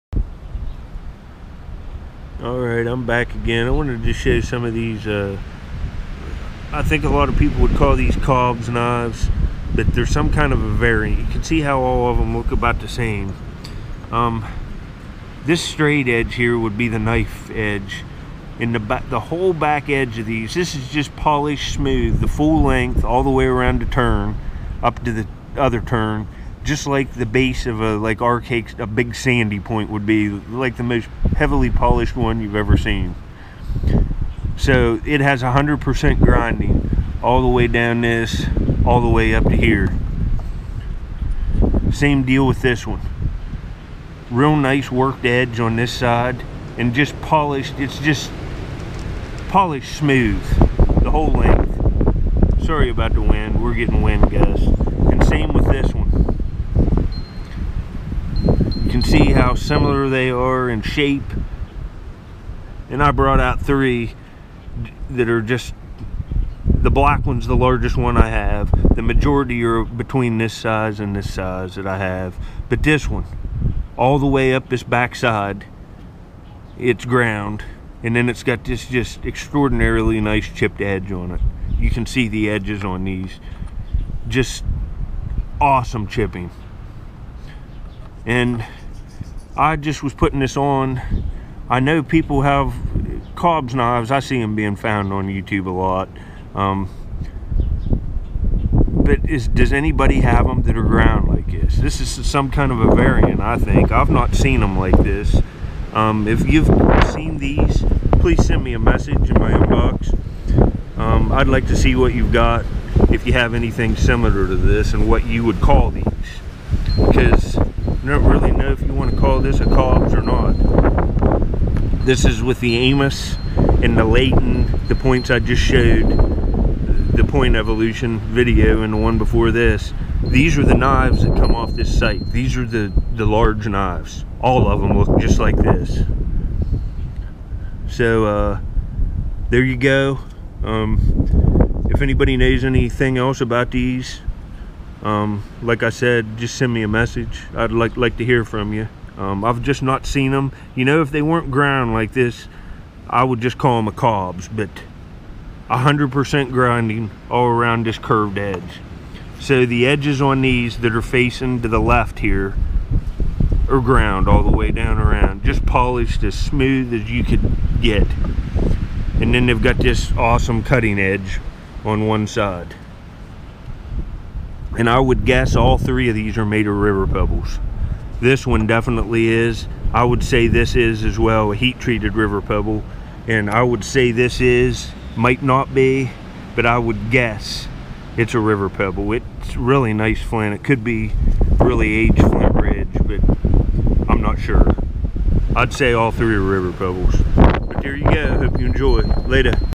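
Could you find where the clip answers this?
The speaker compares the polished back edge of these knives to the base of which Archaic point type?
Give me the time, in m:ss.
0:28.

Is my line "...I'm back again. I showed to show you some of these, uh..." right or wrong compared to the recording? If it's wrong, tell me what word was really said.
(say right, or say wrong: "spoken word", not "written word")
wrong: "wanted", not "showed".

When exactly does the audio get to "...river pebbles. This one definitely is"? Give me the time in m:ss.
2:56.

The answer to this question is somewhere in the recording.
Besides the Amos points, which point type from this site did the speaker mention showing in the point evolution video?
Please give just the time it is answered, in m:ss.
2:04.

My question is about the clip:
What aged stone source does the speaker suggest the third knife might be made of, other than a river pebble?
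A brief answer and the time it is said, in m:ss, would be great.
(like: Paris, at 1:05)
Flint Ridge, at 3:12.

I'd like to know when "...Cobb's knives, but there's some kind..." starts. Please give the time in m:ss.
0:08.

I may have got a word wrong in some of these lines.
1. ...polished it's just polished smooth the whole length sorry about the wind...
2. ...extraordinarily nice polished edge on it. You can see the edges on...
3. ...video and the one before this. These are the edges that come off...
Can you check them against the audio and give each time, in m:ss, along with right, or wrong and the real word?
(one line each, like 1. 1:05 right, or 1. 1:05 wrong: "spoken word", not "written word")
1. 0:47 right
2. 1:19 wrong: "chipped", not "polished"
3. 2:08 wrong: "knives", not "edges".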